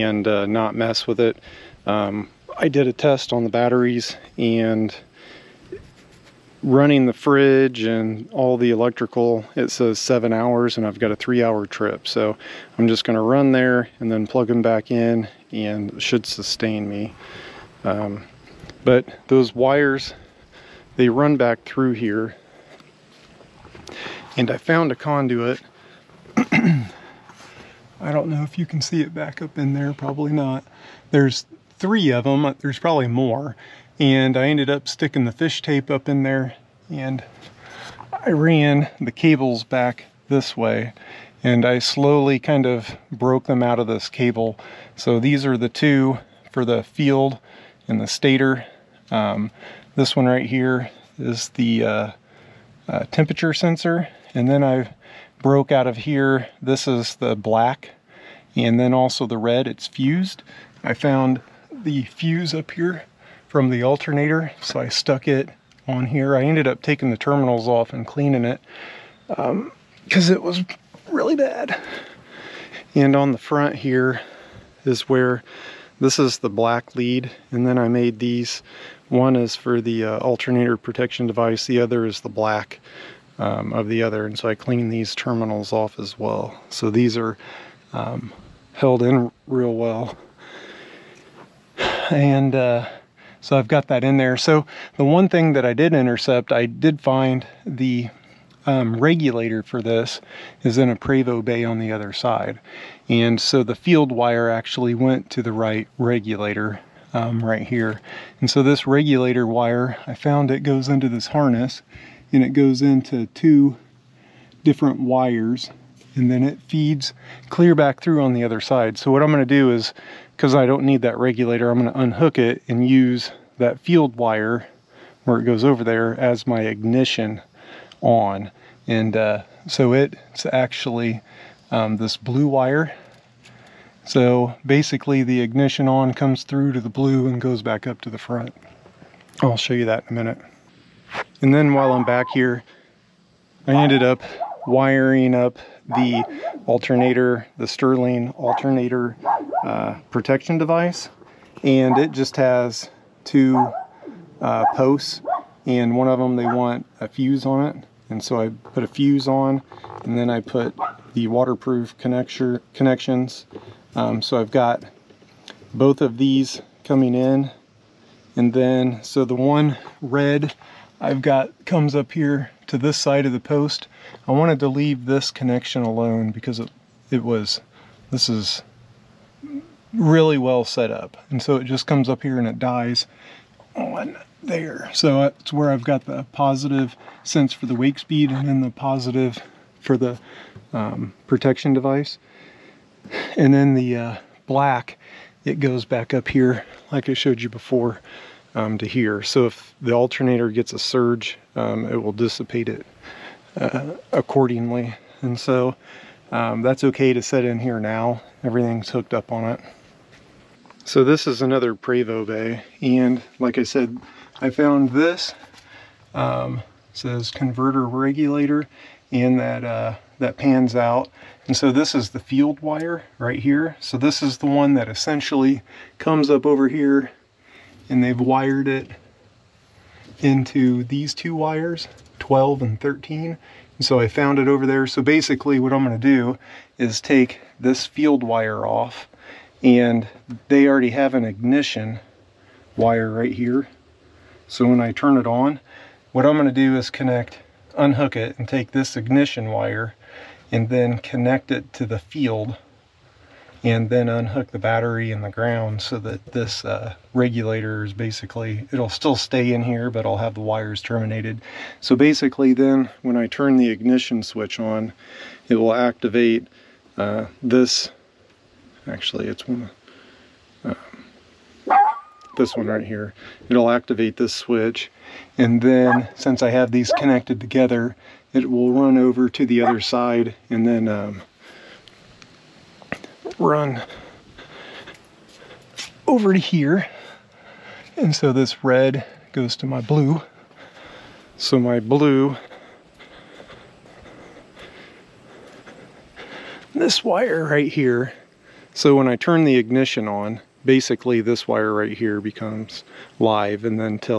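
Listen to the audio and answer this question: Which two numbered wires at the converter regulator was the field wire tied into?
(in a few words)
12 and 13.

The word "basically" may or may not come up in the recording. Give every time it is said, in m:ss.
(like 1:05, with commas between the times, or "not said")
2:14, 3:55, 4:17, 4:21, 5:00.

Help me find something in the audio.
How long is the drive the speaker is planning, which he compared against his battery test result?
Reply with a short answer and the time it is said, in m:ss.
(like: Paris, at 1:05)
3 hours, at 0:11.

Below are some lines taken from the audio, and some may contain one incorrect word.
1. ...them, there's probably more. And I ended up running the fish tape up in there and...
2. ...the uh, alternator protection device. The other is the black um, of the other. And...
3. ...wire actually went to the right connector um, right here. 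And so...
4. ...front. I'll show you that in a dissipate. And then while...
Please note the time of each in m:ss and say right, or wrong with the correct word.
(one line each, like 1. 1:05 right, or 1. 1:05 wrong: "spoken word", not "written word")
1. 0:32 wrong: "sticking", not "running"
2. 1:19 right
3. 1:44 wrong: "regulator", not "connector"
4. 2:18 wrong: "minute", not "dissipate".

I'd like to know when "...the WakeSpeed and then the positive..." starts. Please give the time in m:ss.
3:07.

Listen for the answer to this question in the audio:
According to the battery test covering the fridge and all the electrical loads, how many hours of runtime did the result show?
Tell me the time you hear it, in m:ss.
0:09.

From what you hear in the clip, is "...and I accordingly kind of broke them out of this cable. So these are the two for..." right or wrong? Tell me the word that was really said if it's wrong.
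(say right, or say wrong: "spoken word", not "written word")
wrong: "slowly", not "accordingly".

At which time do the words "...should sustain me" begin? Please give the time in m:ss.
0:16.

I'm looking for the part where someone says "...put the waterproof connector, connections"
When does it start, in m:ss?
2:40.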